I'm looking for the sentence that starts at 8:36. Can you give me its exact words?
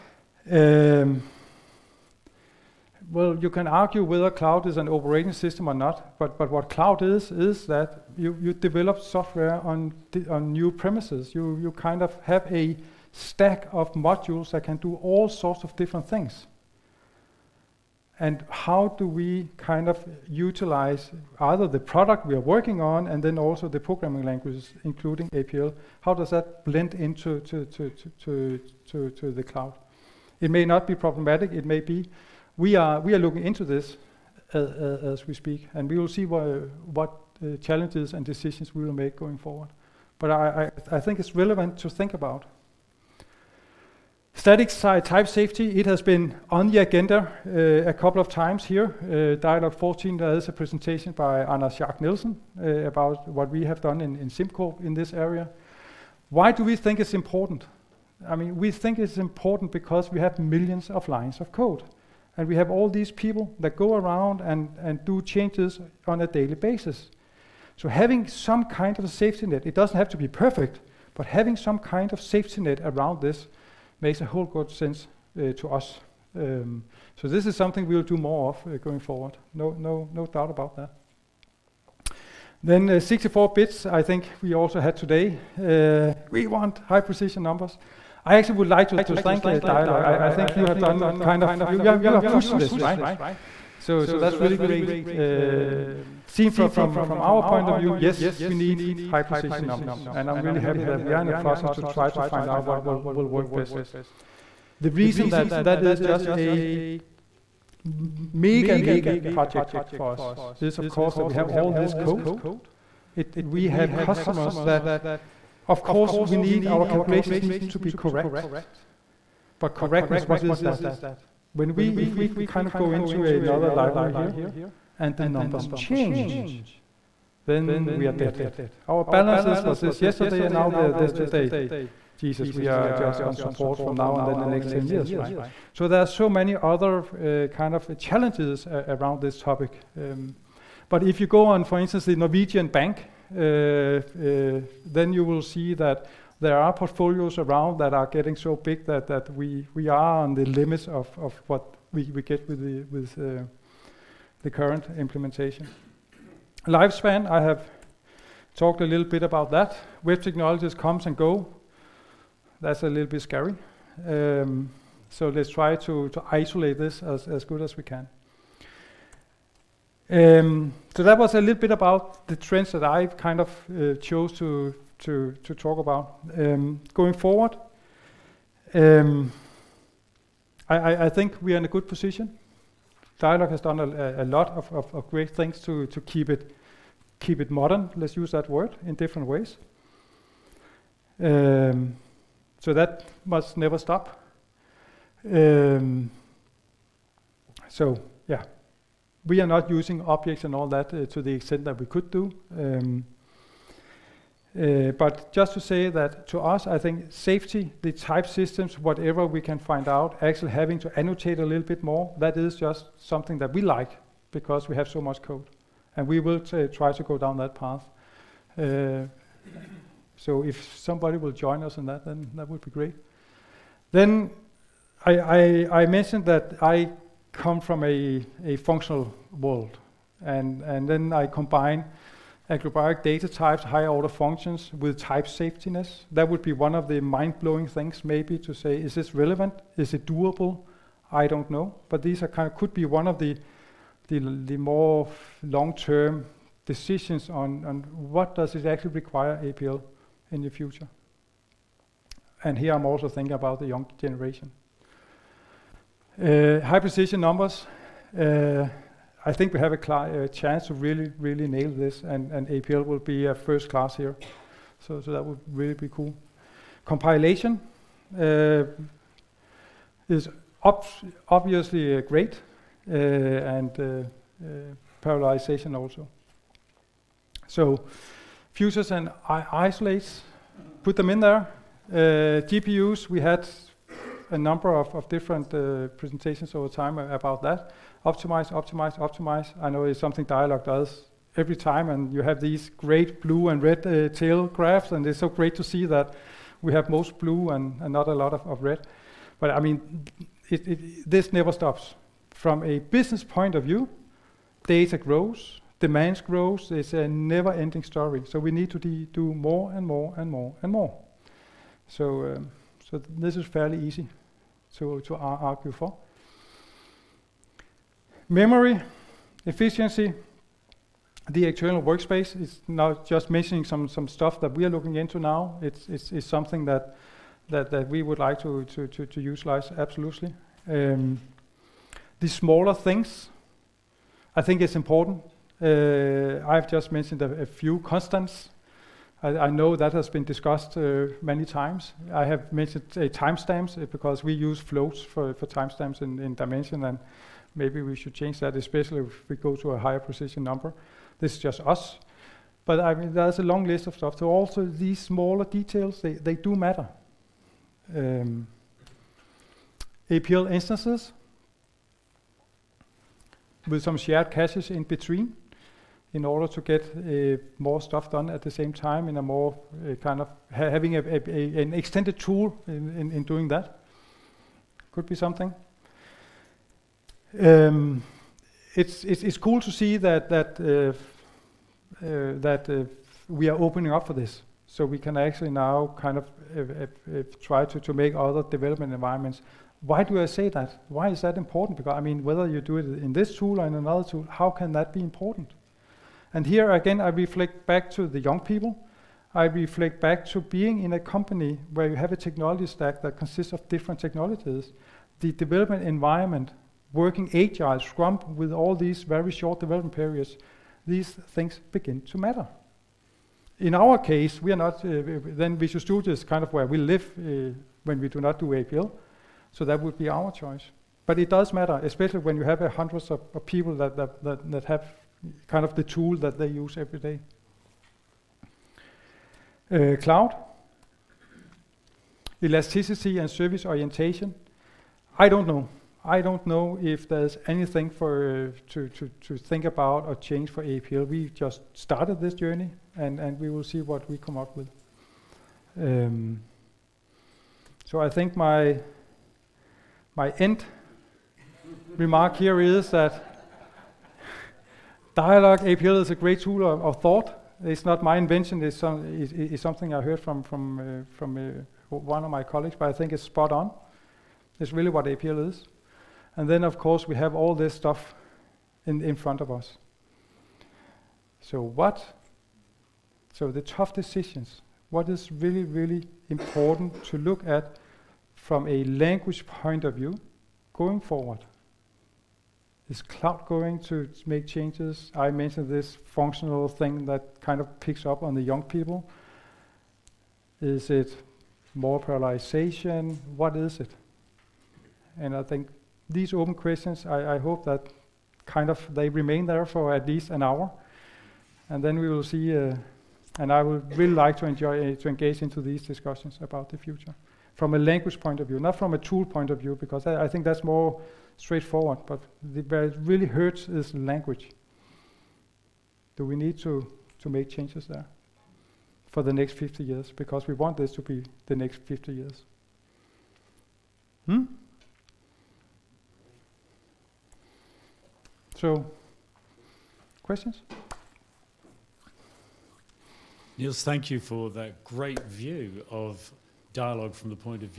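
Do we need to, to make changes there for the next 50 years?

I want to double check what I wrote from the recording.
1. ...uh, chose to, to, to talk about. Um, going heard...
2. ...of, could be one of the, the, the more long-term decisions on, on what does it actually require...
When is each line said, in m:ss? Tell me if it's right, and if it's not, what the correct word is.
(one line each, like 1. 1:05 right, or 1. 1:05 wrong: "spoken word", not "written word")
1. 2:53 wrong: "forward", not "heard"
2. 4:02 right.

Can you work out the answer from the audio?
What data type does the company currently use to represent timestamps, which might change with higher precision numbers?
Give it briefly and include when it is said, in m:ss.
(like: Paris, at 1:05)
floats, at 5:44.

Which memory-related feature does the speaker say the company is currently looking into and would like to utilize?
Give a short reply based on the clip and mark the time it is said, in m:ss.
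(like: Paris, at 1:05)
the external workspace, at 5:21.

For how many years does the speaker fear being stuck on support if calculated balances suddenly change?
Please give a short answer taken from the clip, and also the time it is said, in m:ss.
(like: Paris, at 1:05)
10, at 2:14.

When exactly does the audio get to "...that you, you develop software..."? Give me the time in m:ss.
0:07.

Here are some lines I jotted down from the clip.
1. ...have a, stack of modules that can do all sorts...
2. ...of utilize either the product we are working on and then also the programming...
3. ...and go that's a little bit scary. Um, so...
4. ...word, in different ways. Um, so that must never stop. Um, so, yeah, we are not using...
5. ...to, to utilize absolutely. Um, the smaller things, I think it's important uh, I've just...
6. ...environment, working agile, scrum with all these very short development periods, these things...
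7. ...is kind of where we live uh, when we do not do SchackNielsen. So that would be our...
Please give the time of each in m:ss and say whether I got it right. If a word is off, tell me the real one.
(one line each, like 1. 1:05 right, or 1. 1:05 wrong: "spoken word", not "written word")
1. 0:12 right
2. 0:19 right
3. 2:41 right
4. 3:08 right
5. 5:28 right
6. 6:45 right
7. 6:56 wrong: "APL", not "SchackNielsen".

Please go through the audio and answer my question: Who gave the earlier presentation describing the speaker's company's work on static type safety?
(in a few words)
Anders Schack-Nielsen.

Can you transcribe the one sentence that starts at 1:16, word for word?
Um, so this is something we'll do more of uh, going forward.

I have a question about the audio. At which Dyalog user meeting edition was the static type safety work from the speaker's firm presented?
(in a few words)
Dyalog 14.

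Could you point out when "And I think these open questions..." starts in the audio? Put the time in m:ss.
8:15.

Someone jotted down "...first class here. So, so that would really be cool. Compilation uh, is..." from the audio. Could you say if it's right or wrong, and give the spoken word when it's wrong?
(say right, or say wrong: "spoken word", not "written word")
right.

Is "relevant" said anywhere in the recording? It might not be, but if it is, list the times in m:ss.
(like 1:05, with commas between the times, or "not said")
0:41, 3:59.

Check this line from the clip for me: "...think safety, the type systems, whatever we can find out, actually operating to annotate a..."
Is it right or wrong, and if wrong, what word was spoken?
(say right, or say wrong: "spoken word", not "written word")
wrong: "having", not "operating".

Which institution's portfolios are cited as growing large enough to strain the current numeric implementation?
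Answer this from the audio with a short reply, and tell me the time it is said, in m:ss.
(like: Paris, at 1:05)
the Norwegian bank, at 2:22.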